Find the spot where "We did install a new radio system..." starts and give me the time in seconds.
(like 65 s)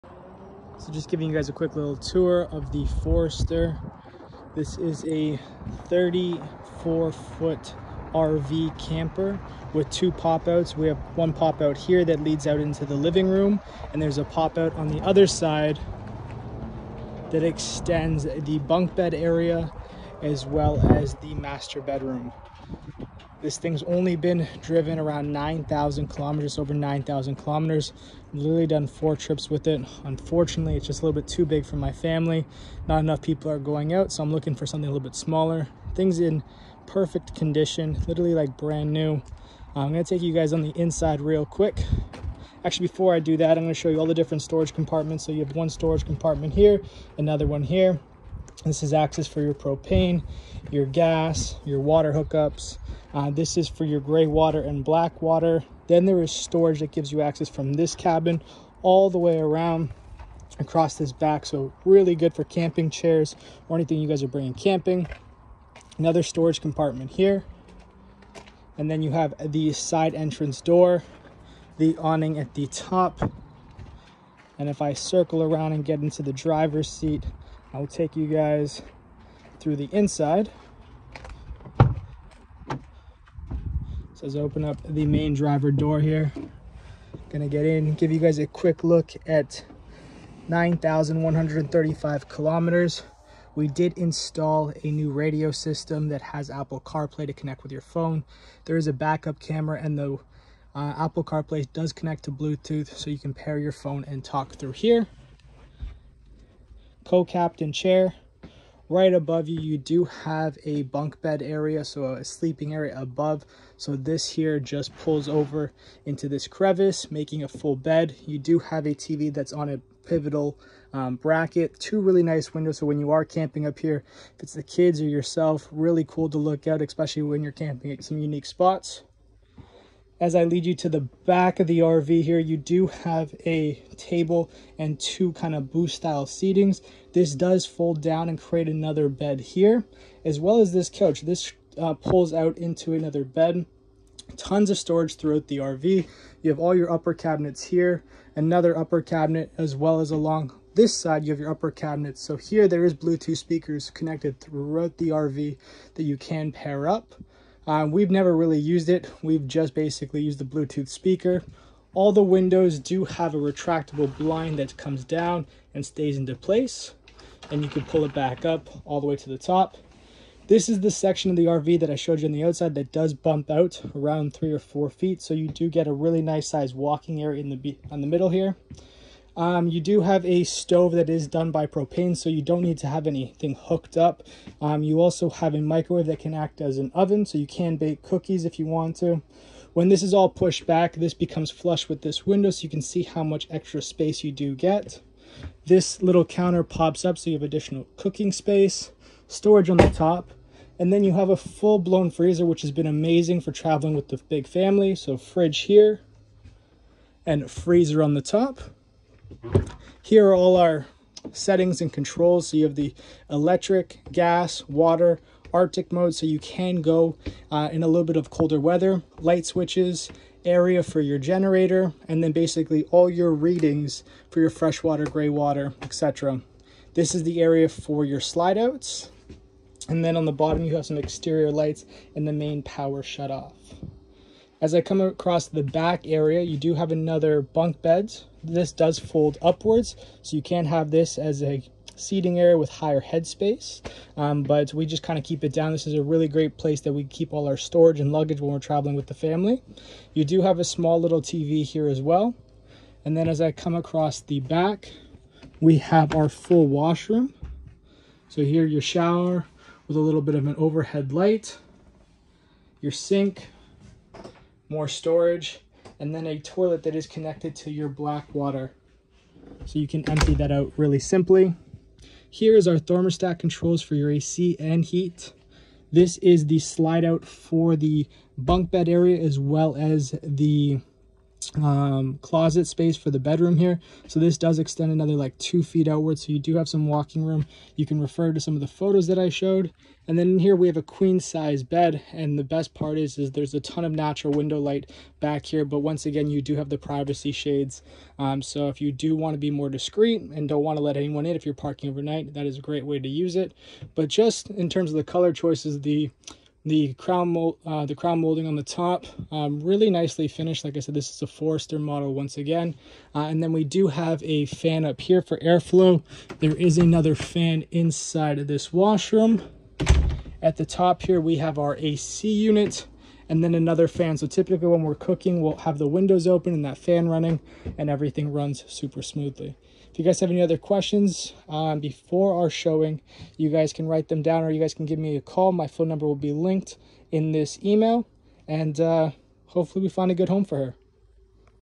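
93 s.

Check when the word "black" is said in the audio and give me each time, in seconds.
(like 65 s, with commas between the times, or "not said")
54 s, 267 s.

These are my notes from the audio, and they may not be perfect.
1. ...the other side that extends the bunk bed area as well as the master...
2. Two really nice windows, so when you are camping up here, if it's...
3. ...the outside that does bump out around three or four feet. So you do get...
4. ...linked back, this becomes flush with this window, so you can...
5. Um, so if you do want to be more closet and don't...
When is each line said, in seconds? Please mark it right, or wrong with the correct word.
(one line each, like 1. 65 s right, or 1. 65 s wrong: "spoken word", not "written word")
1. 14 s right
2. 121 s right
3. 172 s right
4. 190 s wrong: "pushed", not "linked"
5. 298 s wrong: "discreet", not "closet".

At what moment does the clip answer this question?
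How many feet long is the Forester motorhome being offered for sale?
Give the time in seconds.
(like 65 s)
5 s.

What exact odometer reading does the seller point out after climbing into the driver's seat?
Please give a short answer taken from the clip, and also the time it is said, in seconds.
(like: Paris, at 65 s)
9,135 kilometers, at 90 s.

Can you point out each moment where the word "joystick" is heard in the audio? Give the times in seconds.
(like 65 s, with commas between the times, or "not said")
not said.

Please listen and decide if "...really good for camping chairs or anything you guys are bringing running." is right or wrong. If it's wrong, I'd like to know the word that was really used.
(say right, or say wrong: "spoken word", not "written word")
wrong: "camping", not "running".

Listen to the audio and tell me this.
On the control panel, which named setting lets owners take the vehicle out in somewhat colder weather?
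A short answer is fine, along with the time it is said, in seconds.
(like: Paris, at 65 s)
Arctic mode, at 215 s.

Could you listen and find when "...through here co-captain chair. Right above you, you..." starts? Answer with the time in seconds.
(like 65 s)
104 s.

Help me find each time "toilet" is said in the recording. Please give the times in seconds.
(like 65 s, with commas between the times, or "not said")
266 s.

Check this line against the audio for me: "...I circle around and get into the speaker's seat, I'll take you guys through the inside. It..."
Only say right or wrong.
wrong.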